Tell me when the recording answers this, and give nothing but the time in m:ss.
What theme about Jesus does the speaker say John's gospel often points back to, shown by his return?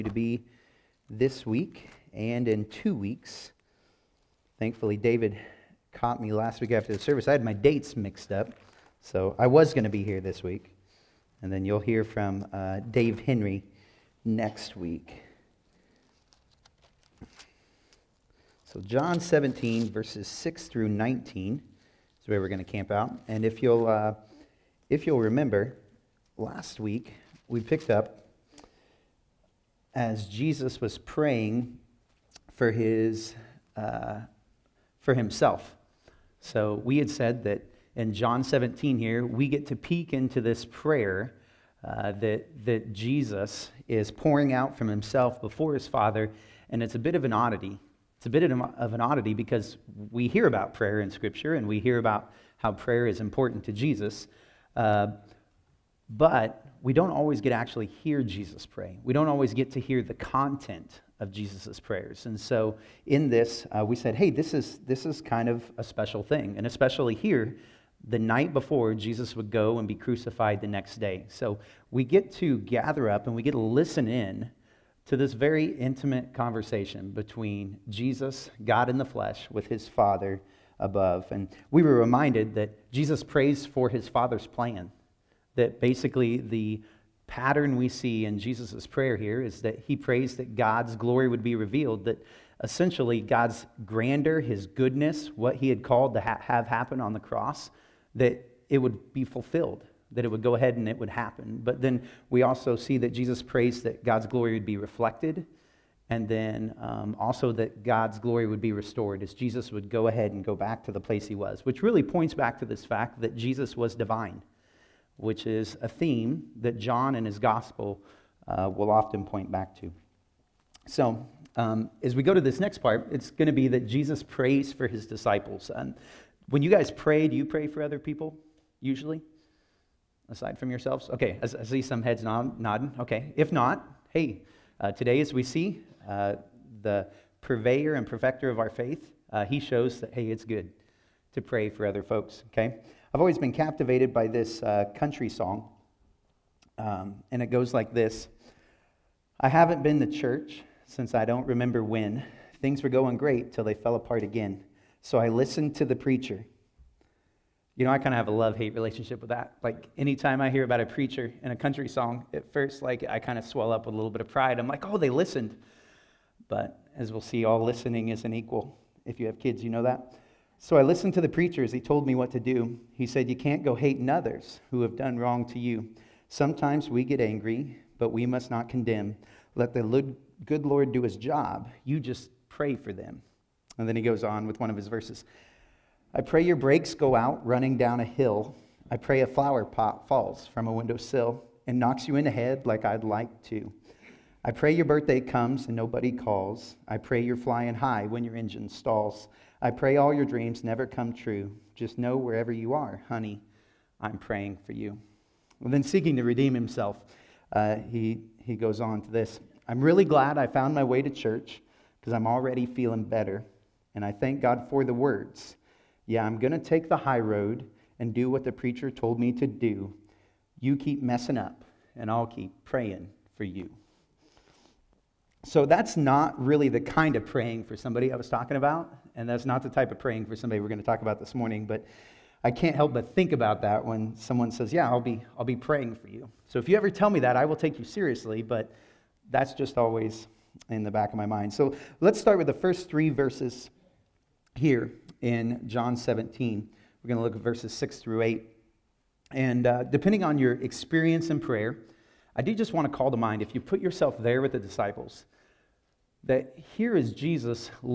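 1:53.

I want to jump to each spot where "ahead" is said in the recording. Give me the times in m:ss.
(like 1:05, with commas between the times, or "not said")
1:40, 1:50.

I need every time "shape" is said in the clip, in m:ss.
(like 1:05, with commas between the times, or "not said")
not said.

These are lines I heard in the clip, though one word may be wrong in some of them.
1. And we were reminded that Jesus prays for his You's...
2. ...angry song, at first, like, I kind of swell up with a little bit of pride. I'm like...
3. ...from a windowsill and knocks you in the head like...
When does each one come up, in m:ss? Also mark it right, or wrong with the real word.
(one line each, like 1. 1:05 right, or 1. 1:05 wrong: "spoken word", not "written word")
1. 1:21 wrong: "Father", not "You"
2. 2:41 wrong: "country", not "angry"
3. 3:10 right.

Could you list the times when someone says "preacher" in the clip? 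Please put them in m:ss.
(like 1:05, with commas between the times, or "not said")
2:35, 2:40, 2:51, 3:38.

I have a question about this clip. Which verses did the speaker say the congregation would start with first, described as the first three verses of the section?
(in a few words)
6 through 8.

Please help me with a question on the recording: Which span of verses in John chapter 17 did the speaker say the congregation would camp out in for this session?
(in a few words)
6 through 19.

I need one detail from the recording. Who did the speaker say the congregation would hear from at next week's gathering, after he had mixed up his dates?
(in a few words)
Dave Henry.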